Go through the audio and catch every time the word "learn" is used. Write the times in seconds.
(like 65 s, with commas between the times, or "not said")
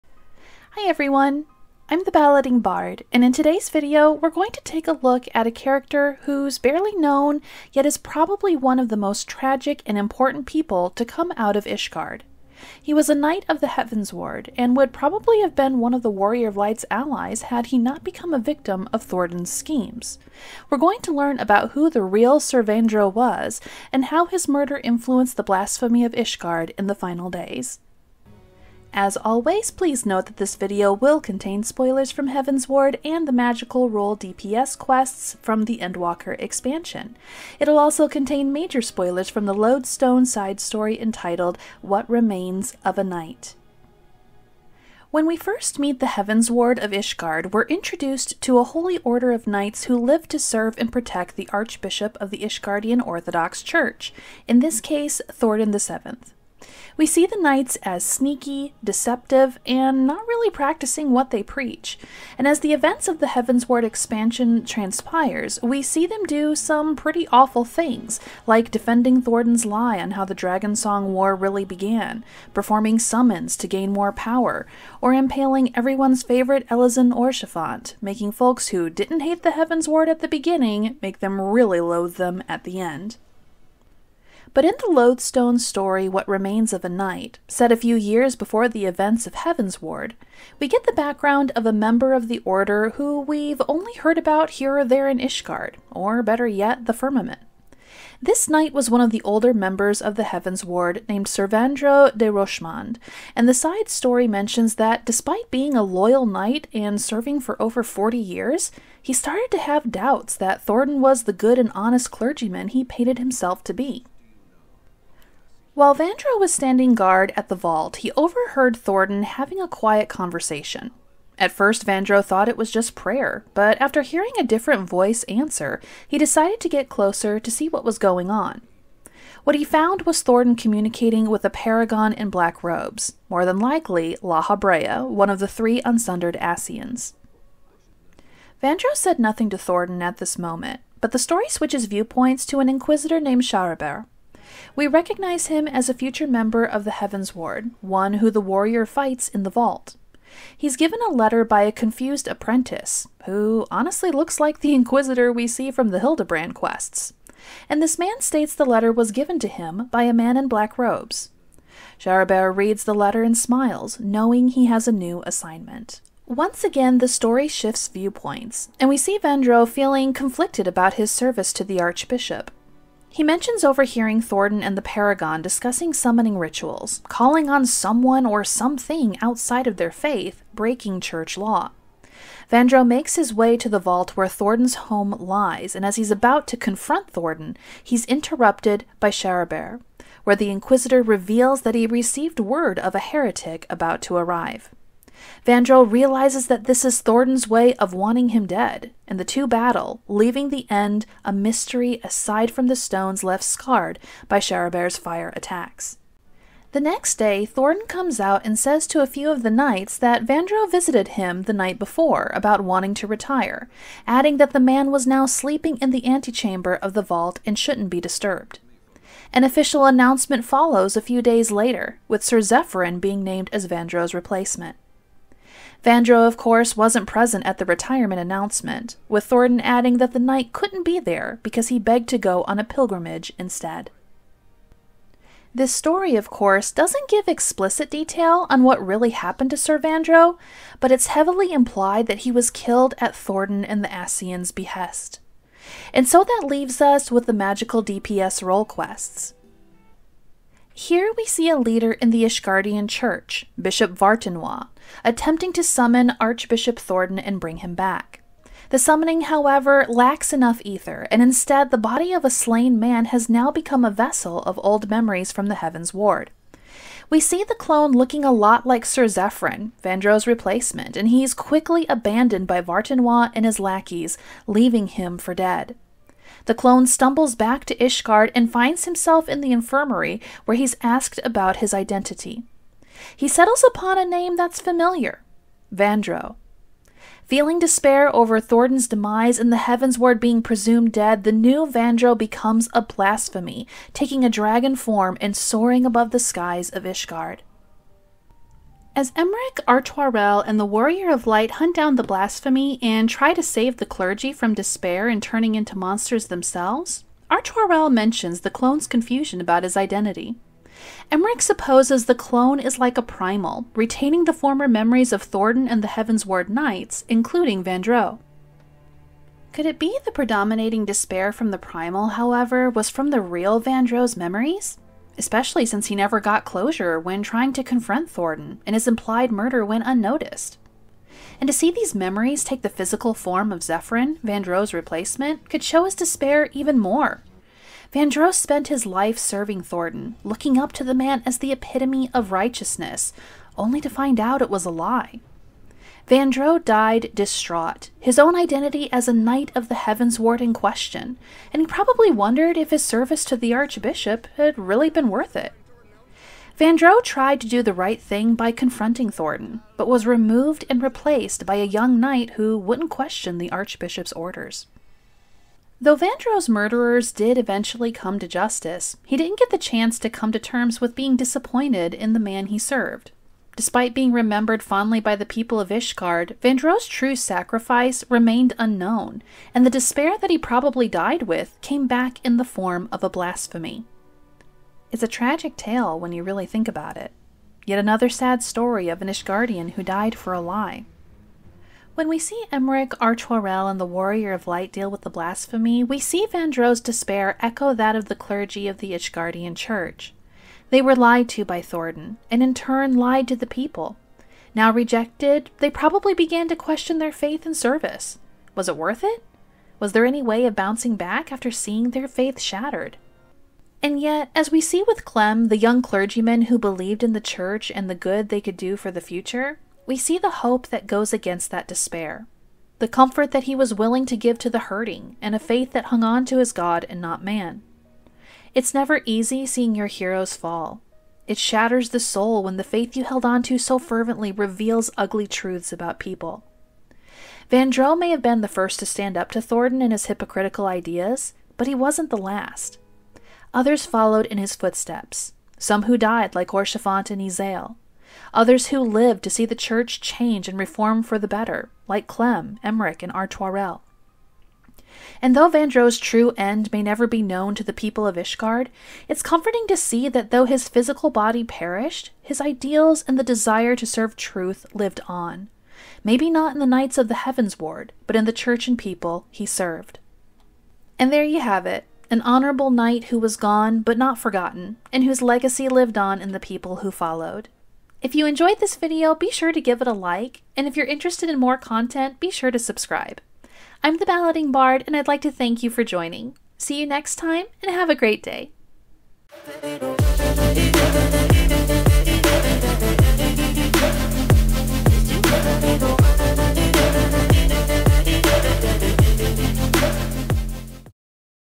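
21 s.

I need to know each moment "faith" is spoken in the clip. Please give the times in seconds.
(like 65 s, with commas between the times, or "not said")
179 s, 407 s, 412 s, 425 s, 432 s.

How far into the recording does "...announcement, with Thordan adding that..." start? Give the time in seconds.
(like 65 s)
228 s.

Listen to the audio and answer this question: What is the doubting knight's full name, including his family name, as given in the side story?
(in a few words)
Ser Vaindreau de Rochemond.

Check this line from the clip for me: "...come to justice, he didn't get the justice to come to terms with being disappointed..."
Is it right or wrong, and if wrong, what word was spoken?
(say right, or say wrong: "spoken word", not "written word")
wrong: "chance", not "justice".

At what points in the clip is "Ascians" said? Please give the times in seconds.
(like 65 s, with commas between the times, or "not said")
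136 s, 243 s.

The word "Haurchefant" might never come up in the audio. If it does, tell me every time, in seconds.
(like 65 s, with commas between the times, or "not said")
77 s, 446 s.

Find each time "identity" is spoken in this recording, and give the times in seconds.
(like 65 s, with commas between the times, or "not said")
281 s, 309 s, 348 s.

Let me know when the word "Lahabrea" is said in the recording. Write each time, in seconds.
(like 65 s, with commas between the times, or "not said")
134 s.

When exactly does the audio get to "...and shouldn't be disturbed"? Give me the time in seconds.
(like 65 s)
217 s.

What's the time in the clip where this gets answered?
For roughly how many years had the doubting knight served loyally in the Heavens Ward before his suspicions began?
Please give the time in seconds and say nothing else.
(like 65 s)
107 s.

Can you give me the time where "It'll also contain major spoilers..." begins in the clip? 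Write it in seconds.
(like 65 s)
37 s.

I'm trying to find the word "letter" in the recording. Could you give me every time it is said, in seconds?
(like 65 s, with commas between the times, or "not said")
151 s, 158 s, 162 s.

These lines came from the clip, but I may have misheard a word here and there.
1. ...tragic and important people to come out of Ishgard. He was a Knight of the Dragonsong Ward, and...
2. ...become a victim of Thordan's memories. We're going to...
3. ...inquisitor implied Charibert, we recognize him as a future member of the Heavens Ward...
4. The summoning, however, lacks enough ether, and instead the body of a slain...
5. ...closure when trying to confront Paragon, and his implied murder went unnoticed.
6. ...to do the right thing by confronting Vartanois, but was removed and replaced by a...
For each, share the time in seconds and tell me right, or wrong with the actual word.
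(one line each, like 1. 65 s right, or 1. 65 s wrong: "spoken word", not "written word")
1. 9 s wrong: "Heavens", not "Dragonsong"
2. 18 s wrong: "schemes", not "memories"
3. 142 s wrong: "named", not "implied"
4. 258 s right
5. 326 s wrong: "Thordan", not "Paragon"
6. 357 s wrong: "Thordan", not "Vartanois".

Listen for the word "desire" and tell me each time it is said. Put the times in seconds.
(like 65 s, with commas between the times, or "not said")
463 s.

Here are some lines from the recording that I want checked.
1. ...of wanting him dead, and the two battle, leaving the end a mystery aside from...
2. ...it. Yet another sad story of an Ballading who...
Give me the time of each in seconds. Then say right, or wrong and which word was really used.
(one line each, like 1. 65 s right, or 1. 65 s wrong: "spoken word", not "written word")
1. 197 s right
2. 386 s wrong: "Ishgardian", not "Ballading".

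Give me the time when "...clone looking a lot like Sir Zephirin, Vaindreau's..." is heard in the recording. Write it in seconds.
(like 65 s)
267 s.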